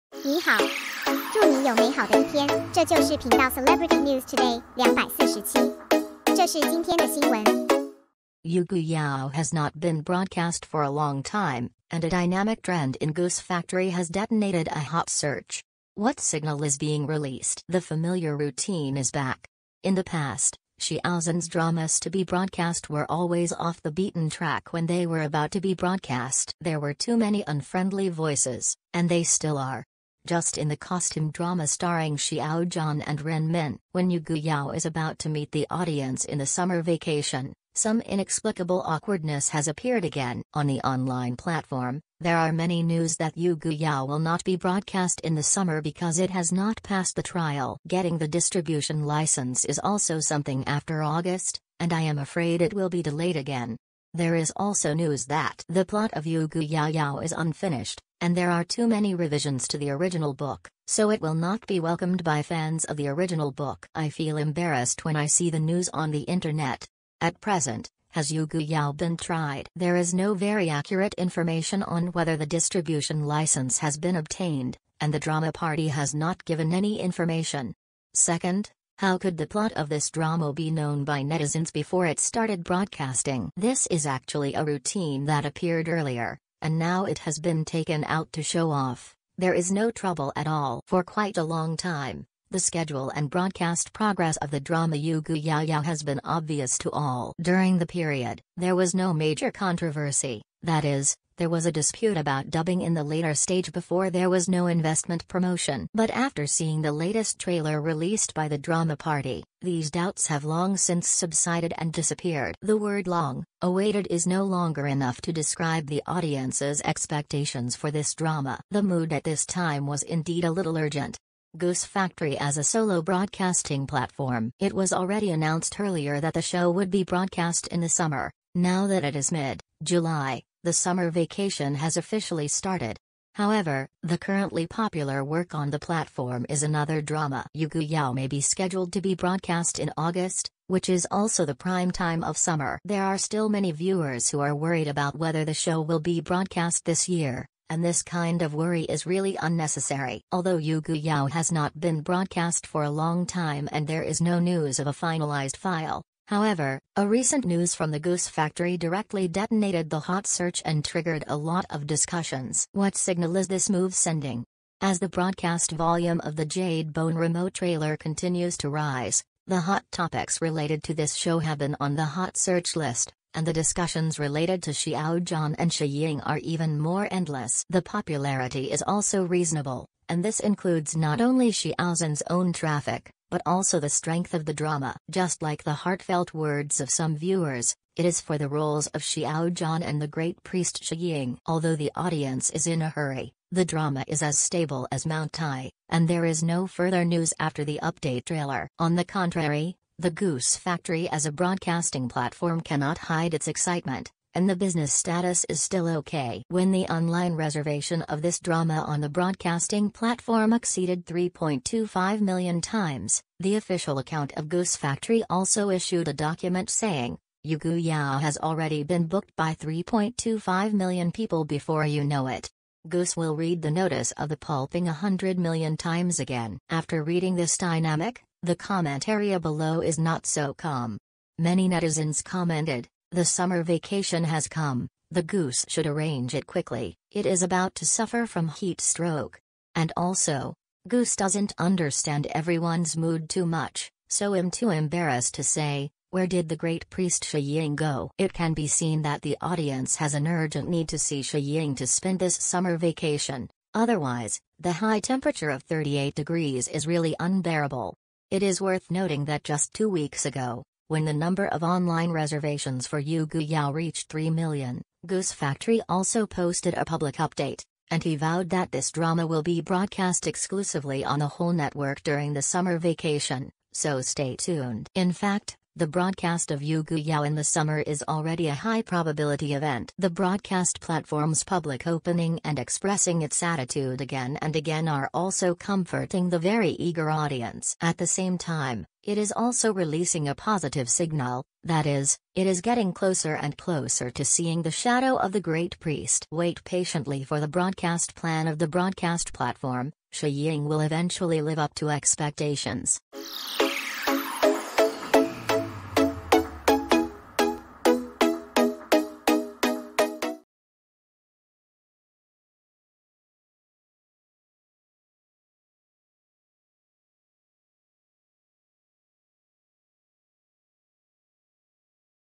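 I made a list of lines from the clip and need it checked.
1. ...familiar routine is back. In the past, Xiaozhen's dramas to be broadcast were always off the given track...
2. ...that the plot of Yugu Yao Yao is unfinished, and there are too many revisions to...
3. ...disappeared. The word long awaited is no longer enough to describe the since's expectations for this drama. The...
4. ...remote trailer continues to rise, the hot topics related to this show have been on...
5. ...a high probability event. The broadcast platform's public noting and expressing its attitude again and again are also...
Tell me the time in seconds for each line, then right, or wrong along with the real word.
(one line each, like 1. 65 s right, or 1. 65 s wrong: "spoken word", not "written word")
1. 17 s wrong: "beaten", not "given"
2. 55 s right
3. 111 s wrong: "audience", not "since"
4. 167 s right
5. 278 s wrong: "opening", not "noting".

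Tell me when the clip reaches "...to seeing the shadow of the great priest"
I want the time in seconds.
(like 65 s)
294 s.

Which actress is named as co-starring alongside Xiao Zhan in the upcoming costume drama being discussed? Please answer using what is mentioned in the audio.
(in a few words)
Ren Min.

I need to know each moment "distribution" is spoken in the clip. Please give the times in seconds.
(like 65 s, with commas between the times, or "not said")
48 s, 72 s.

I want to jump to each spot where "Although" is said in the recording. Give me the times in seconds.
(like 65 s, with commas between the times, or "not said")
150 s, 191 s.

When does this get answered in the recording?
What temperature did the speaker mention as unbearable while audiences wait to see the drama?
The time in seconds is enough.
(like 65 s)
255 s.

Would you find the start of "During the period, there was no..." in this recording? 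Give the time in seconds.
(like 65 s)
97 s.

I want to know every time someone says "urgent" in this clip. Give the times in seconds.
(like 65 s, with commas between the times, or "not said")
120 s, 250 s.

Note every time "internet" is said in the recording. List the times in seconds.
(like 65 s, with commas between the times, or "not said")
66 s.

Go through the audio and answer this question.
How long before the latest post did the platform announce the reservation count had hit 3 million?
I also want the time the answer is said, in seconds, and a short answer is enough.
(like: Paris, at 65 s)
two weeks, at 259 s.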